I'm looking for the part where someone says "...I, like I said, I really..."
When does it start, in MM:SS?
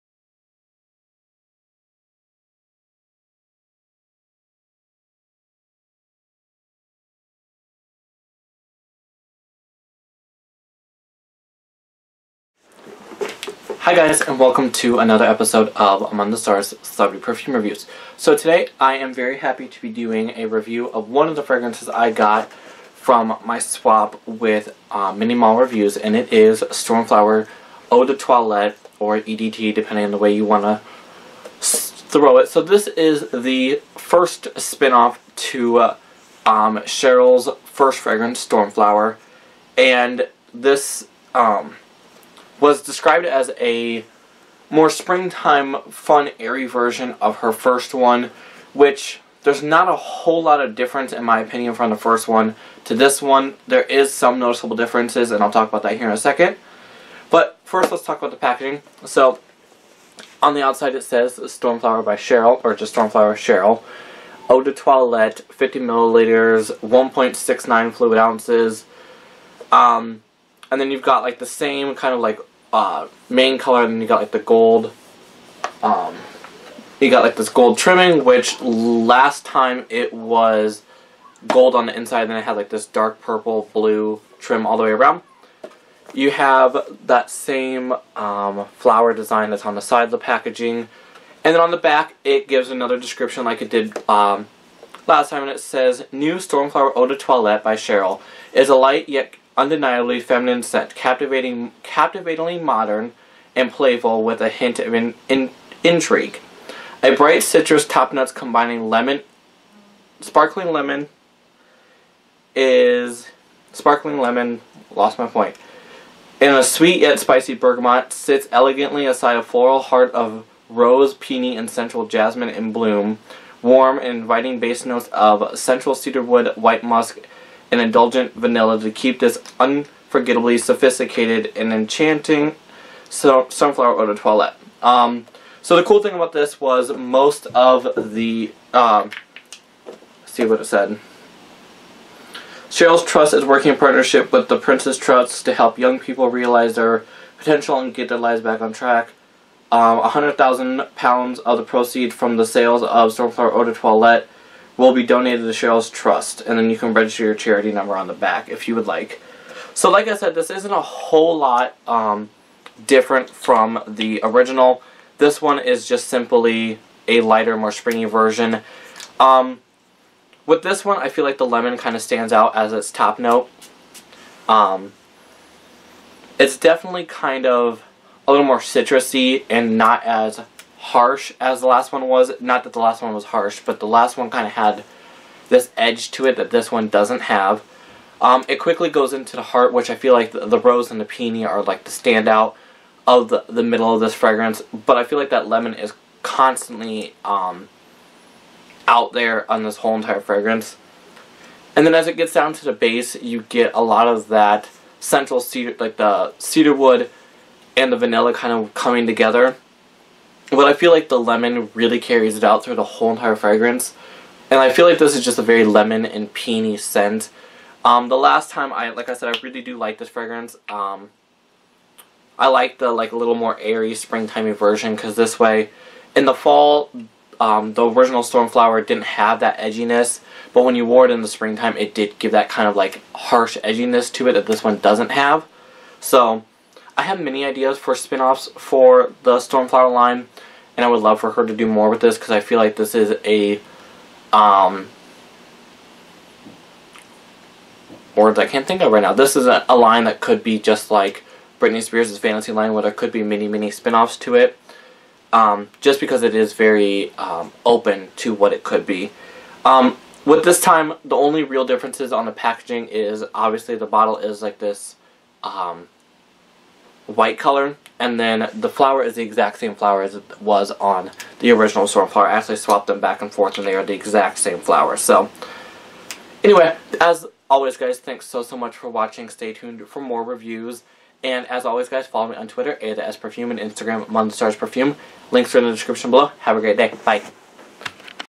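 03:38.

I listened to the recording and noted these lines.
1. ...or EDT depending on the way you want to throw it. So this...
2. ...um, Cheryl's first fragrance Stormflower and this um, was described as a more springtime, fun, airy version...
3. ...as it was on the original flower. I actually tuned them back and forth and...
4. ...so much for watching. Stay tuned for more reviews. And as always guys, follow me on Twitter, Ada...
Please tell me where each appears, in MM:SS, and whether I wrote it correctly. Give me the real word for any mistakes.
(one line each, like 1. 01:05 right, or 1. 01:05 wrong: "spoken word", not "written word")
1. 00:28 right
2. 00:36 right
3. 04:30 wrong: "swapped", not "tuned"
4. 04:38 right.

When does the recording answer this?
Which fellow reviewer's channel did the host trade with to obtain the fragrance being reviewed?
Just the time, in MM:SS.
00:25.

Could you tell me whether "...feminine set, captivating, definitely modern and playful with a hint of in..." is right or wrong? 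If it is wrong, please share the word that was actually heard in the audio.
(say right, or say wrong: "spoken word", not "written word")
wrong: "captivatingly", not "definitely".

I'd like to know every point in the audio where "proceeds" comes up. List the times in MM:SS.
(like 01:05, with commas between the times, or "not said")
02:31.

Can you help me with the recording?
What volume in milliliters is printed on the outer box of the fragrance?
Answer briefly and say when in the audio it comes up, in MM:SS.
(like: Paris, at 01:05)
50 milliliters, at 01:05.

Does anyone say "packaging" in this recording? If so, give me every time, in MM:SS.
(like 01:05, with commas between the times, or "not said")
00:58, 01:30, 04:22.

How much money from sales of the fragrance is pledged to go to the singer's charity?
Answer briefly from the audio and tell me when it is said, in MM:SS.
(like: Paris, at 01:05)
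100,000 pounds, at 02:29.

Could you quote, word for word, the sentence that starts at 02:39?
So like I said, this isn't a whole lot um, different from the original.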